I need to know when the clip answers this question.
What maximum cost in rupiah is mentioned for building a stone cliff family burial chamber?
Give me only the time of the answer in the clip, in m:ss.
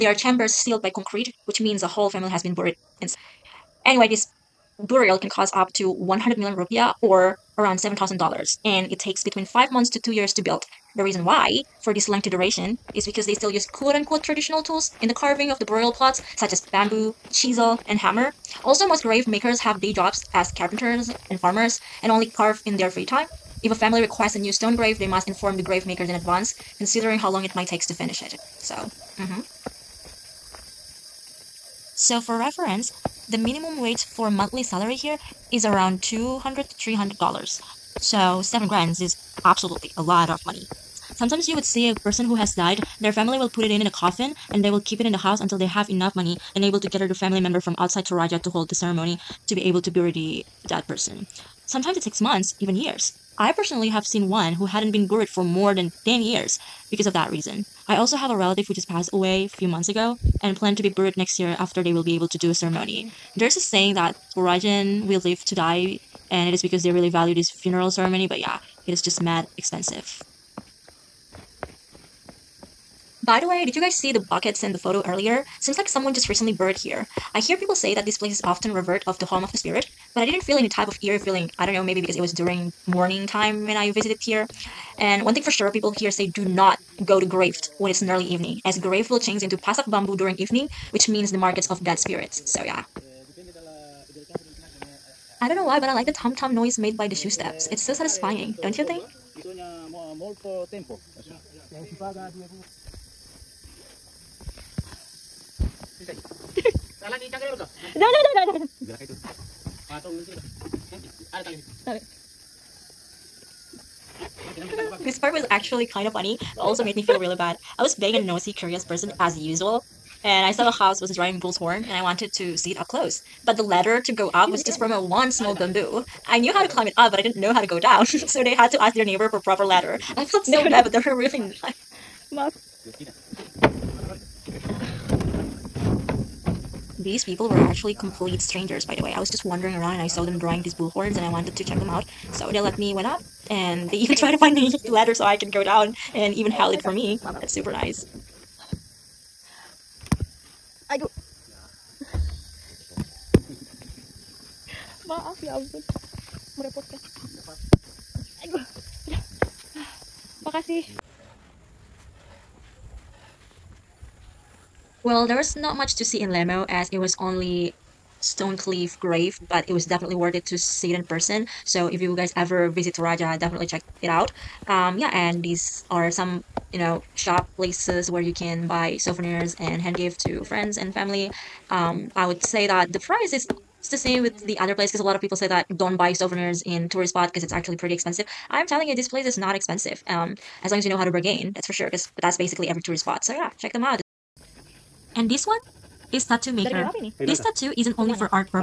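0:05.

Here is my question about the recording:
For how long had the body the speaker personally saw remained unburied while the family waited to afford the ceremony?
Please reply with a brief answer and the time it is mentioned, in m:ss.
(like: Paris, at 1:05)
More than 10 years, at 0:55.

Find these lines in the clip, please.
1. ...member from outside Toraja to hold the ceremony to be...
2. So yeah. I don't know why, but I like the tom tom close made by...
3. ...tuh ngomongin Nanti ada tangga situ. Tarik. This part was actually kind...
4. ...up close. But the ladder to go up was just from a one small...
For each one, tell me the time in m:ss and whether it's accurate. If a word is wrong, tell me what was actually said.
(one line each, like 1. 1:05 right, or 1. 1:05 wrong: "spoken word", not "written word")
1. 0:47 right
2. 1:32 wrong: "noise", not "close"
3. 1:50 right
4. 2:02 right.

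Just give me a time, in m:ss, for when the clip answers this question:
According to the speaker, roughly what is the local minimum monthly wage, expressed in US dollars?
0:36.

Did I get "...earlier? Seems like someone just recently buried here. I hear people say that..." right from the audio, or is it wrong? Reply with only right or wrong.
right.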